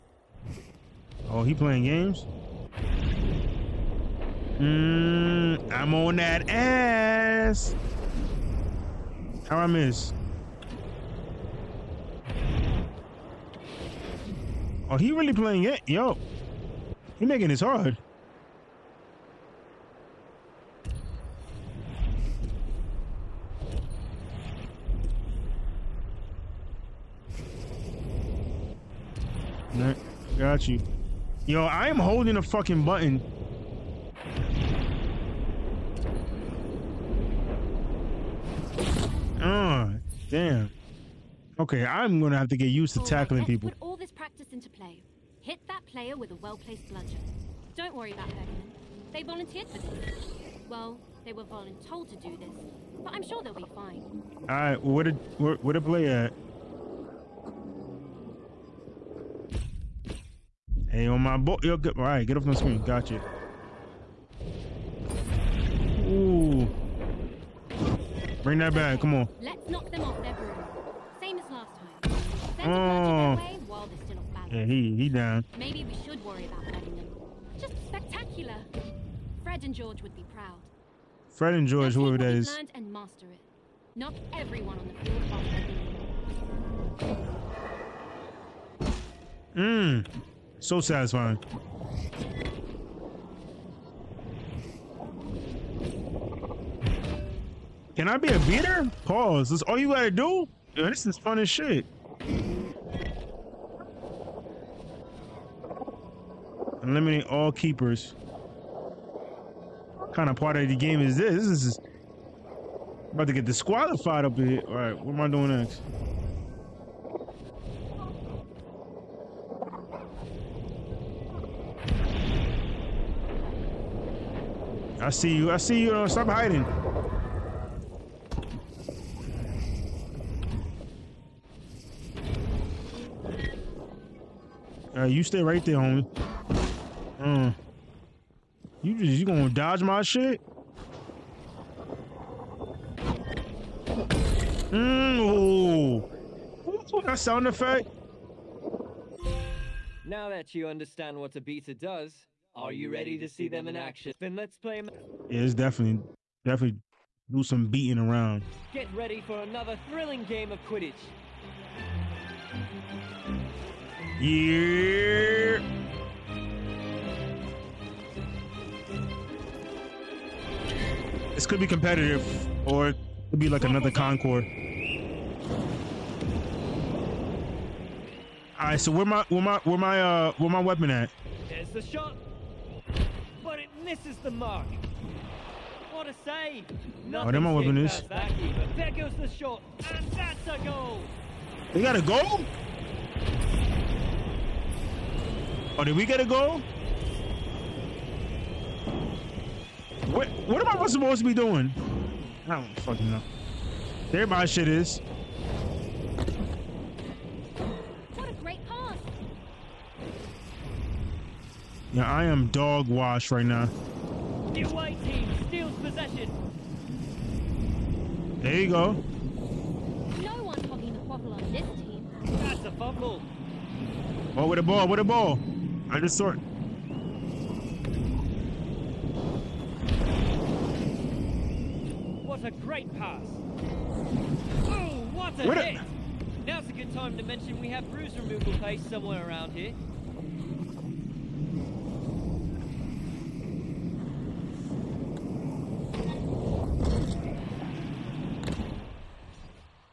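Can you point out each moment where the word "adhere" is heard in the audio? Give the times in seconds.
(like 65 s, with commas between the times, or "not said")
not said.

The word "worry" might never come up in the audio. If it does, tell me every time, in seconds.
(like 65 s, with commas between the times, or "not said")
47 s, 76 s.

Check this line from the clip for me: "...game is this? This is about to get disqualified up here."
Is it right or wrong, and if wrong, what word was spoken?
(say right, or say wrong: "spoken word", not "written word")
right.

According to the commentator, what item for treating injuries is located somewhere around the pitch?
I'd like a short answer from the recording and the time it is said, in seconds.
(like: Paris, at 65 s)
bruise removal paste, at 237 s.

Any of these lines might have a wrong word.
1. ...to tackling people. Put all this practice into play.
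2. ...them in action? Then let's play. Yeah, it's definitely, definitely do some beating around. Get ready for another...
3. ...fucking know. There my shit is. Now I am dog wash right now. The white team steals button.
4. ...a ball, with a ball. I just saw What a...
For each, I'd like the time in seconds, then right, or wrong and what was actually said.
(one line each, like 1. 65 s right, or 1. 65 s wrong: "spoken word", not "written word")
1. 42 s right
2. 153 s right
3. 202 s wrong: "possession", not "button"
4. 224 s right.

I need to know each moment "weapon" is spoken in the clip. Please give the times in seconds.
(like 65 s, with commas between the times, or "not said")
180 s, 187 s.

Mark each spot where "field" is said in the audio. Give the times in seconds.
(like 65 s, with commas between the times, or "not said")
85 s.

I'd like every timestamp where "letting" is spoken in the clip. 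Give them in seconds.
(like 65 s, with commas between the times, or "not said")
76 s.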